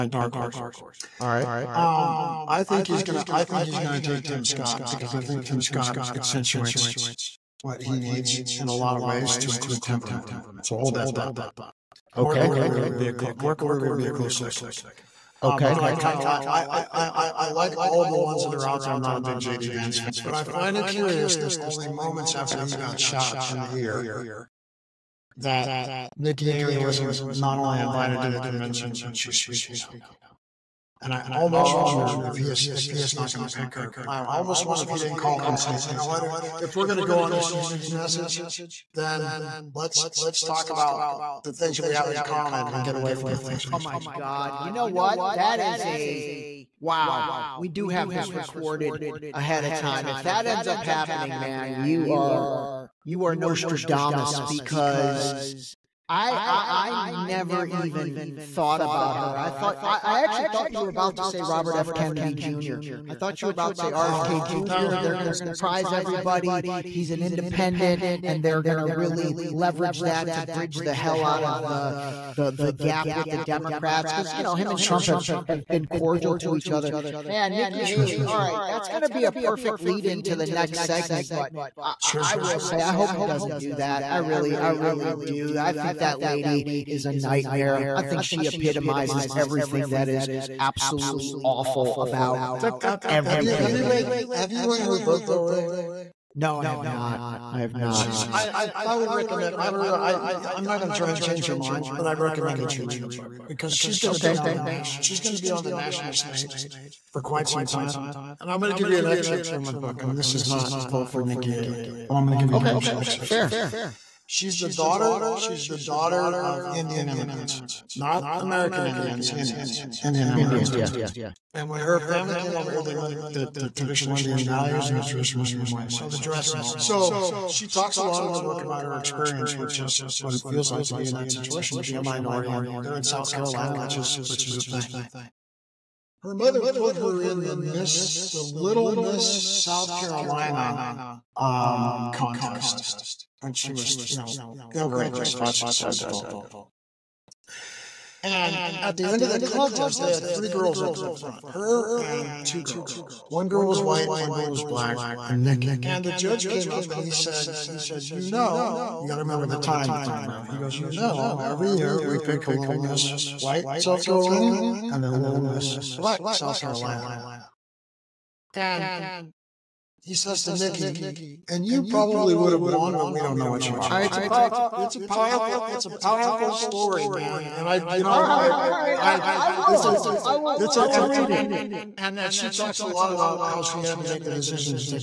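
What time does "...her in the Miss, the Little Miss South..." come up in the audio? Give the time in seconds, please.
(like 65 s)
136 s.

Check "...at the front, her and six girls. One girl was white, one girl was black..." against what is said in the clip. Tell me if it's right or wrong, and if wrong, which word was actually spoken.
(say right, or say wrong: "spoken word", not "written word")
wrong: "two", not "six".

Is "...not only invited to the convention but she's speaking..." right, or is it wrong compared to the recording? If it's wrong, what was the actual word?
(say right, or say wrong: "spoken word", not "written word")
right.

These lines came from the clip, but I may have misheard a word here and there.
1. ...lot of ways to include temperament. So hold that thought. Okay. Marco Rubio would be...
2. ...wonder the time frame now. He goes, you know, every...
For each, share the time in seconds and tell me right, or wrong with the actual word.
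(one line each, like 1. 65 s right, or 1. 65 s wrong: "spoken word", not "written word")
1. 8 s right
2. 159 s wrong: "remember", not "wonder".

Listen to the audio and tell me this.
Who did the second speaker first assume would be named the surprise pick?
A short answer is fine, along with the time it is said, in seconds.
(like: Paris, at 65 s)
Robert F. Kennedy Jr., at 61 s.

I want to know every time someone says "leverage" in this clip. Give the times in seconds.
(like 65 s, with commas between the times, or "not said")
69 s.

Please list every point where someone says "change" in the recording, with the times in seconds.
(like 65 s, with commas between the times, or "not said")
101 s.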